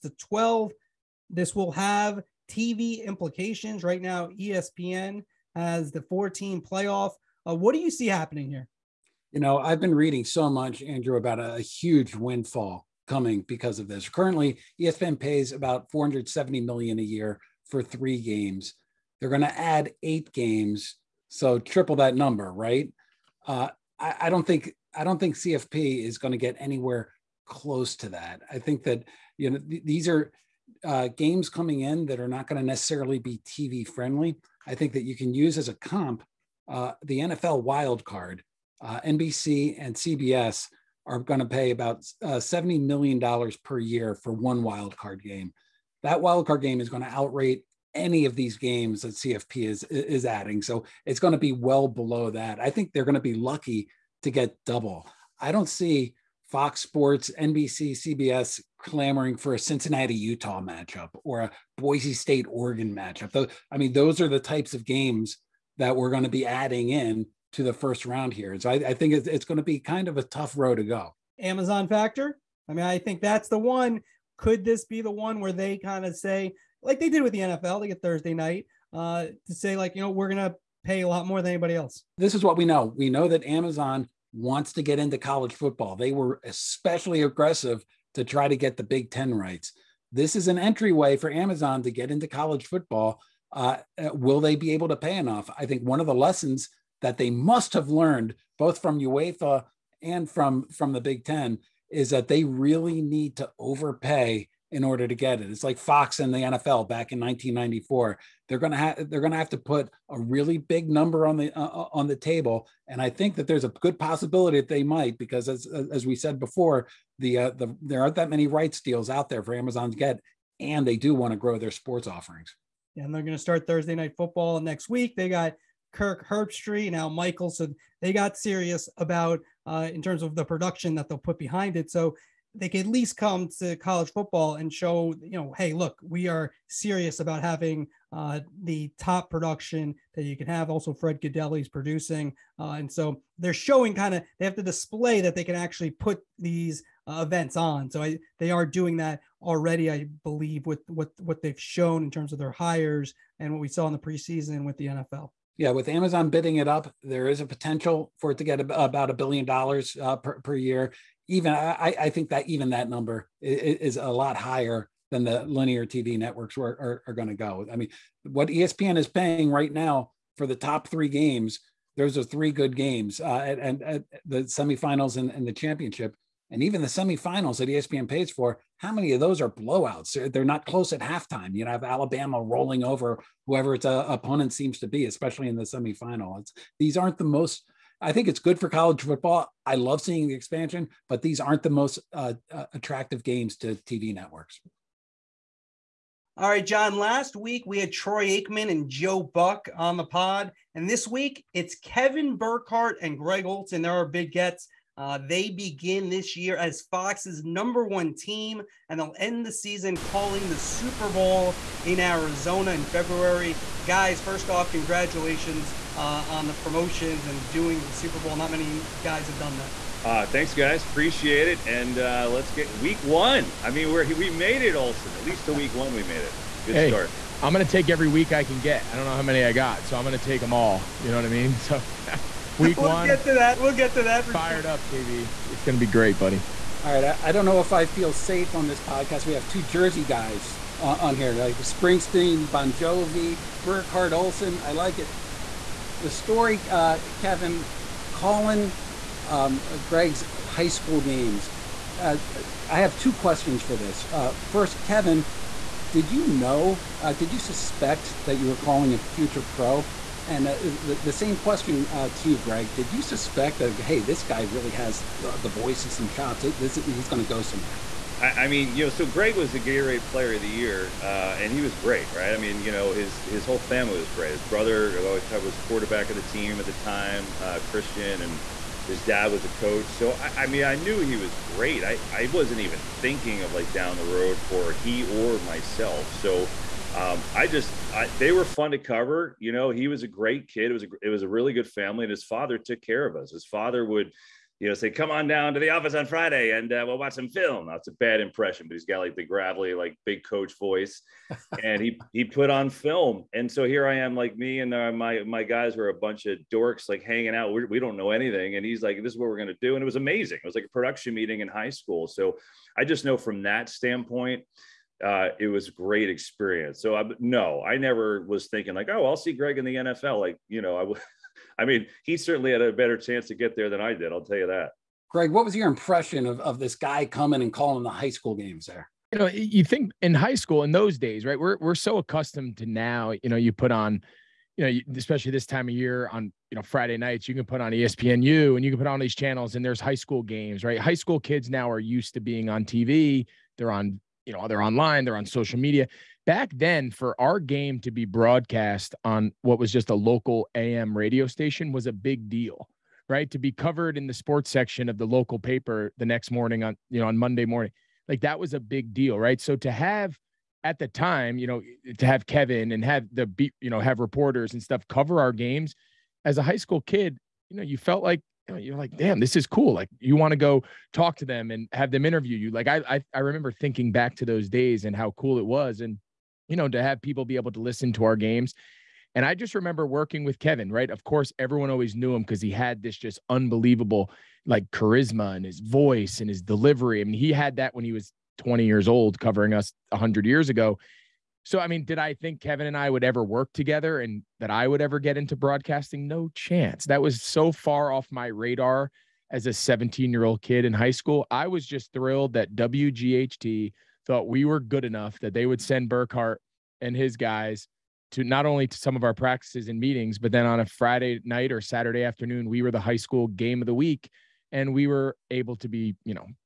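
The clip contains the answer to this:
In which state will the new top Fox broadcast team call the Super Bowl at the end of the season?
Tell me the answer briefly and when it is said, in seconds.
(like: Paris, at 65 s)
Arizona, at 211 s.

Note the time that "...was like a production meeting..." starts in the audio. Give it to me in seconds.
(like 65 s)
310 s.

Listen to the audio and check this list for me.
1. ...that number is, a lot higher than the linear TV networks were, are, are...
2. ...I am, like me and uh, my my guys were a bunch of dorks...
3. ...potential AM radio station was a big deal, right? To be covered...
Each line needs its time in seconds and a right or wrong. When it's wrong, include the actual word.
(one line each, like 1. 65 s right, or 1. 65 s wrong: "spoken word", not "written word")
1. 162 s right
2. 303 s right
3. 349 s wrong: "local", not "potential".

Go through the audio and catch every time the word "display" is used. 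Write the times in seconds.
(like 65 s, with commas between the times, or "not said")
144 s.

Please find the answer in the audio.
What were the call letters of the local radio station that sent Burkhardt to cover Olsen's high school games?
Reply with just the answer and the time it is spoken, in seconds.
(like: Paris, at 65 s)
WGHT, at 402 s.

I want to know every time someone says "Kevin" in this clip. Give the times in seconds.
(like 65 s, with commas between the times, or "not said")
201 s, 247 s, 254 s, 362 s, 380 s, 392 s.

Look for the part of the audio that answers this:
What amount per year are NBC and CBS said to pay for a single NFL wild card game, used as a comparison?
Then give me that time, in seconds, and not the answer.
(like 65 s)
42 s.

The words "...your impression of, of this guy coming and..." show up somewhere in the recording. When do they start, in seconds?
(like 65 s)
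325 s.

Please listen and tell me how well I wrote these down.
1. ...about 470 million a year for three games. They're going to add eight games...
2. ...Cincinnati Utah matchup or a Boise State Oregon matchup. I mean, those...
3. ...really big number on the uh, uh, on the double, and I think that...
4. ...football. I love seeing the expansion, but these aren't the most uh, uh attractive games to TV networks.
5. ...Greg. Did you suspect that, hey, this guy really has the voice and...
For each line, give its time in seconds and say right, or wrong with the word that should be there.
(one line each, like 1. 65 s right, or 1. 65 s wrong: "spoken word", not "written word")
1. 15 s right
2. 59 s right
3. 110 s wrong: "table", not "double"
4. 189 s right
5. 262 s right.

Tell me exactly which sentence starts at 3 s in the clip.
Right now, ESPN as the four team playoff.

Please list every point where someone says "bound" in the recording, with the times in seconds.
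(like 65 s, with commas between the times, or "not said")
not said.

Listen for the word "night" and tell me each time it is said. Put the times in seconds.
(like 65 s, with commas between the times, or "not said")
78 s, 123 s, 336 s, 411 s.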